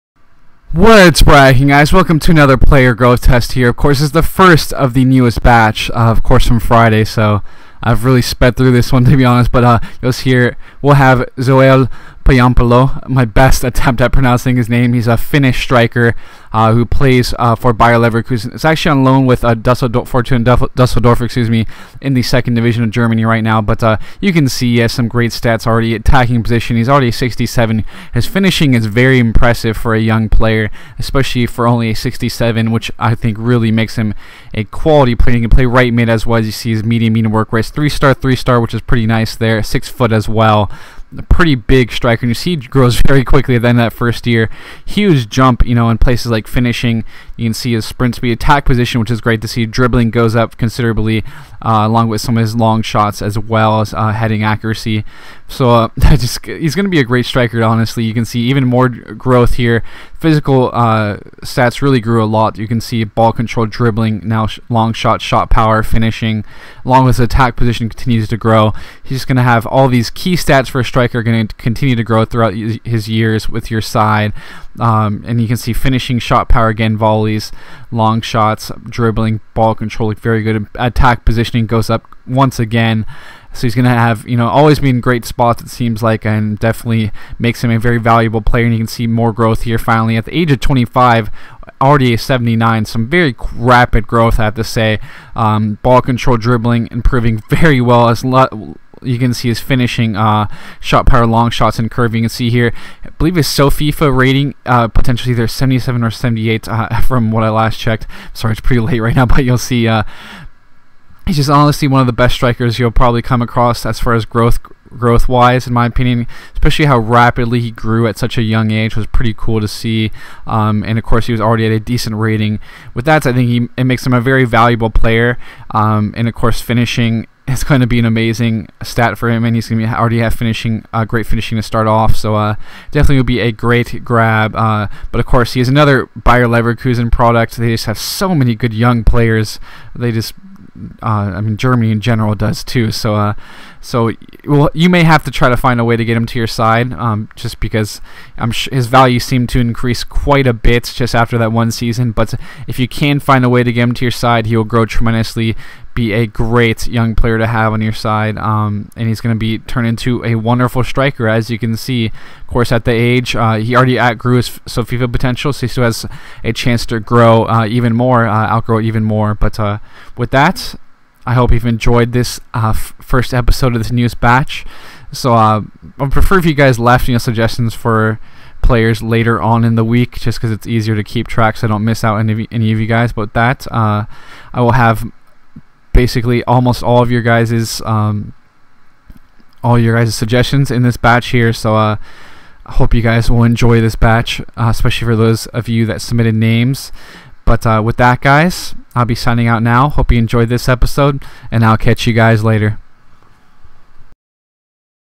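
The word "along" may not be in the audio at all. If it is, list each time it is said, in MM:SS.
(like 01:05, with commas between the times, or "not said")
00:51, 01:06.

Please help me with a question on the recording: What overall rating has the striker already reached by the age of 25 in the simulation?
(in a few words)
79.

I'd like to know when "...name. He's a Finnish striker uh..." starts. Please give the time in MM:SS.
00:14.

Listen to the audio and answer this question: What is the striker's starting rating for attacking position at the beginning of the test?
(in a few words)
67.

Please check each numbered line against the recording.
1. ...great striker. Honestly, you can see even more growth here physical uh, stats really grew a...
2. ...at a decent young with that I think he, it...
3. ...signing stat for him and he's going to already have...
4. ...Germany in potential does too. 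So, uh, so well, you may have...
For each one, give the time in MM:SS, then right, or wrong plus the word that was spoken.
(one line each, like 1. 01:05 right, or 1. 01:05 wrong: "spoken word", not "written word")
1. 00:57 right
2. 02:01 wrong: "rating", not "young"
3. 02:08 wrong: "amazing", not "signing"
4. 02:21 wrong: "general", not "potential".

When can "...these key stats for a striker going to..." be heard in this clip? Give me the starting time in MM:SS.
01:09.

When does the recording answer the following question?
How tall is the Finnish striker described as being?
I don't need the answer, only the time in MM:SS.
00:39.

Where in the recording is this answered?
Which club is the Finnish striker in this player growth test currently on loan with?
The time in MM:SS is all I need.
00:20.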